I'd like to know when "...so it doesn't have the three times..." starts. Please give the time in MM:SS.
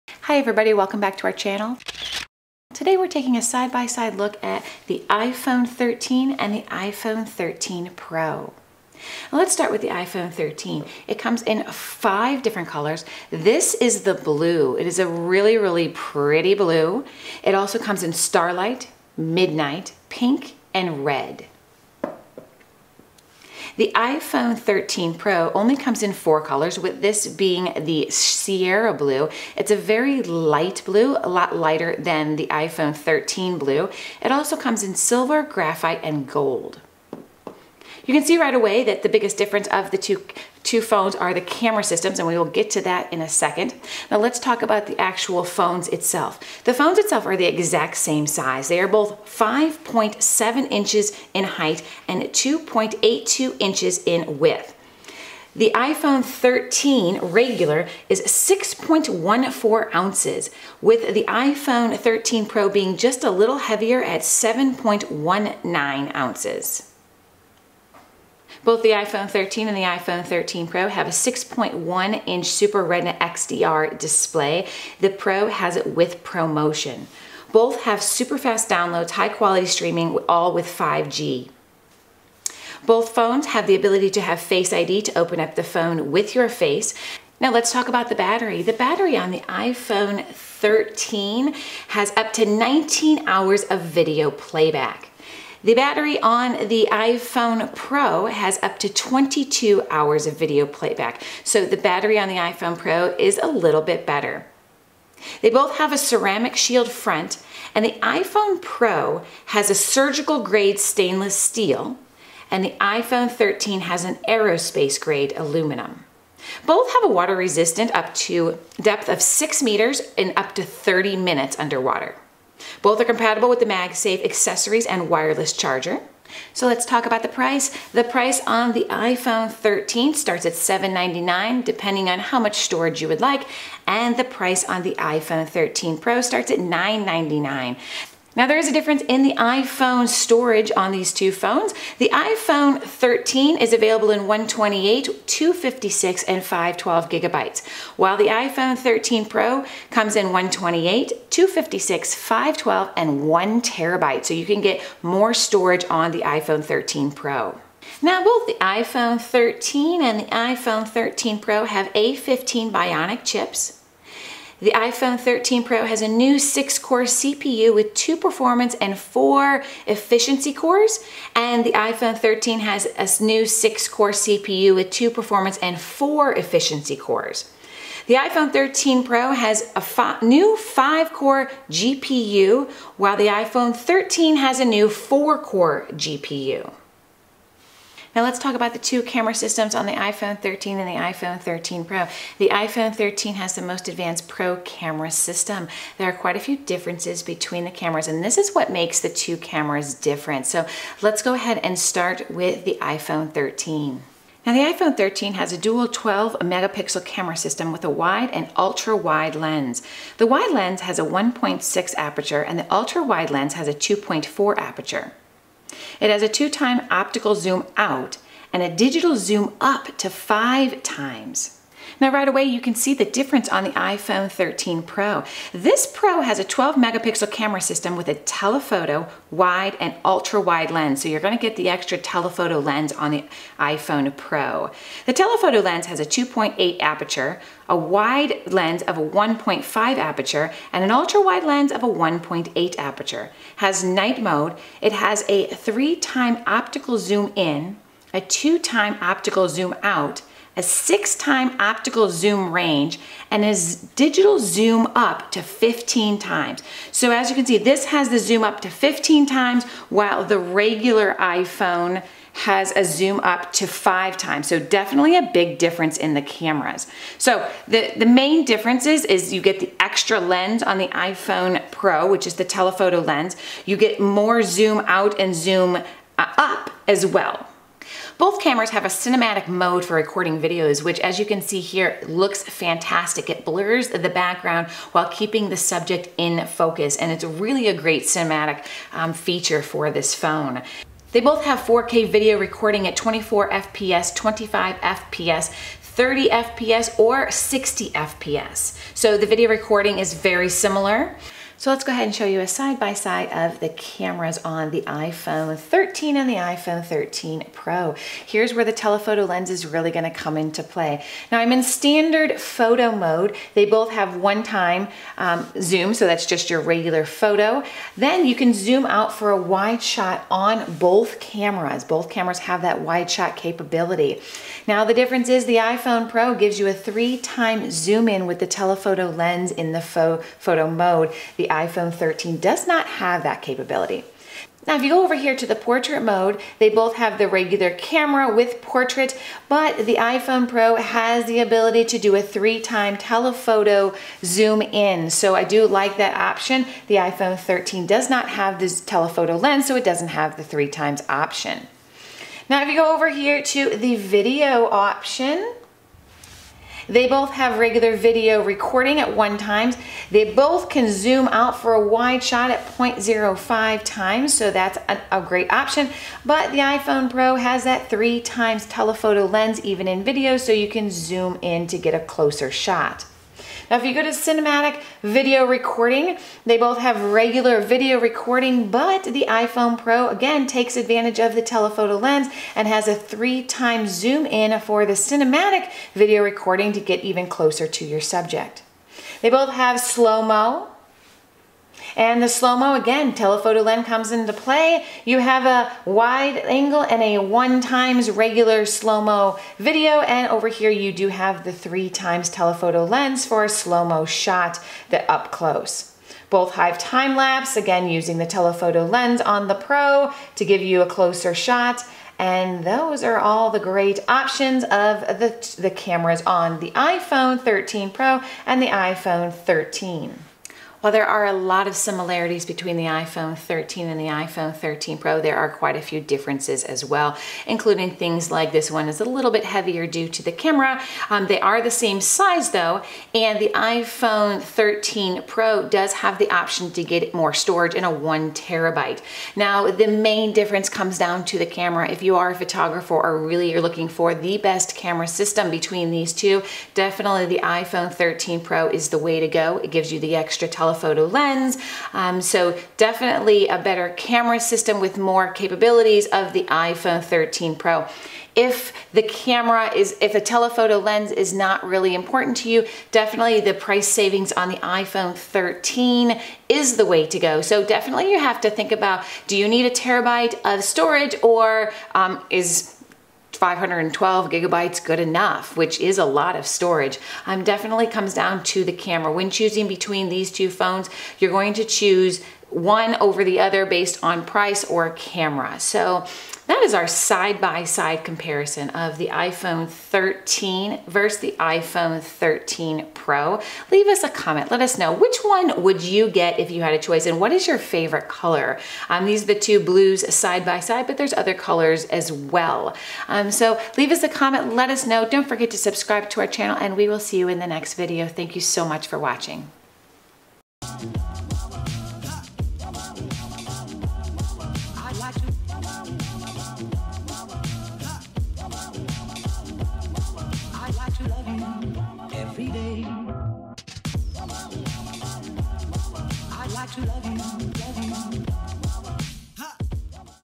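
05:49.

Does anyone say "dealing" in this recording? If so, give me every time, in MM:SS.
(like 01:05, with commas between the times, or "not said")
not said.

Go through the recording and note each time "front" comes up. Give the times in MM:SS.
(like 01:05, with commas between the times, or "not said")
01:46.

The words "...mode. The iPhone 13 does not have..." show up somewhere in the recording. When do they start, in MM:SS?
05:30.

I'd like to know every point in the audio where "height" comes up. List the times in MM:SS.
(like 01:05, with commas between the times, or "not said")
00:51.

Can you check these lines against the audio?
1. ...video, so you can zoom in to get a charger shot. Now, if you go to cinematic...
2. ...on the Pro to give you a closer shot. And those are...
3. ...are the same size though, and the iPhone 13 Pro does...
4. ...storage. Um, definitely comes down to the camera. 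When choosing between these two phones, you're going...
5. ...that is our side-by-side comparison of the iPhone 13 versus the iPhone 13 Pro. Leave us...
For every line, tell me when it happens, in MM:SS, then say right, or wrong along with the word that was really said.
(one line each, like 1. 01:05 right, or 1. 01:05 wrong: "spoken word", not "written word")
1. 06:10 wrong: "closer", not "charger"
2. 06:49 right
3. 07:11 right
4. 07:56 right
5. 08:06 right.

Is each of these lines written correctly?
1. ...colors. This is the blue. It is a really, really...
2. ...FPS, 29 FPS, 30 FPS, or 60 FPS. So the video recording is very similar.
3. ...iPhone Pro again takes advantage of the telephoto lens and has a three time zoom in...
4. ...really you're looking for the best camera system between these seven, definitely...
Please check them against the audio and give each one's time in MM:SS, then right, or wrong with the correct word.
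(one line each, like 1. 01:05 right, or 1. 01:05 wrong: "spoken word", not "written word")
1. 00:12 right
2. 04:53 wrong: "25", not "29"
3. 06:19 right
4. 07:23 wrong: "two", not "seven".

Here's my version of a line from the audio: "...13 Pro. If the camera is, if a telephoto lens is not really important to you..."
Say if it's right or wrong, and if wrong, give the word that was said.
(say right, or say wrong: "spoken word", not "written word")
right.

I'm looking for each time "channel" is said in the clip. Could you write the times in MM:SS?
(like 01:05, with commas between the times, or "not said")
00:01, 08:26.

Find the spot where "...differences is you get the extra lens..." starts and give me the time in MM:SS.
04:28.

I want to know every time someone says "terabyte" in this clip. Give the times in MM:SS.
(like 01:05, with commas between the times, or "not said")
02:33, 07:18, 07:49.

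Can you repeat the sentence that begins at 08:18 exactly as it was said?
Um, these are the two blues side-by-side, -side, but there's other colors as well.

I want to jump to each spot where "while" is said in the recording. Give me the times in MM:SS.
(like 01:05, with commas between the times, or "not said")
02:27, 03:02, 04:19, 04:44, 07:00.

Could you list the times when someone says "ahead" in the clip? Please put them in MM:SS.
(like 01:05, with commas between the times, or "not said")
03:21, 05:01.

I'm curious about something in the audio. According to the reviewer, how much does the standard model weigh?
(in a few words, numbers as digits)
6.14 ounces.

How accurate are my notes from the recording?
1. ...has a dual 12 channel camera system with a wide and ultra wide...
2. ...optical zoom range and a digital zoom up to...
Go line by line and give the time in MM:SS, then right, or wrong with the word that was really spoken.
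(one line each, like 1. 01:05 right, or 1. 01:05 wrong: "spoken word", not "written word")
1. 03:25 wrong: "megapixel", not "channel"
2. 04:11 right.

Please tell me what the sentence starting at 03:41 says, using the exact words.
Now right away you can see the difference on the iPhone 13 Pro.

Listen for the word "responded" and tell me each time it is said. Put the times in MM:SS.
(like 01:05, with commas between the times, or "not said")
not said.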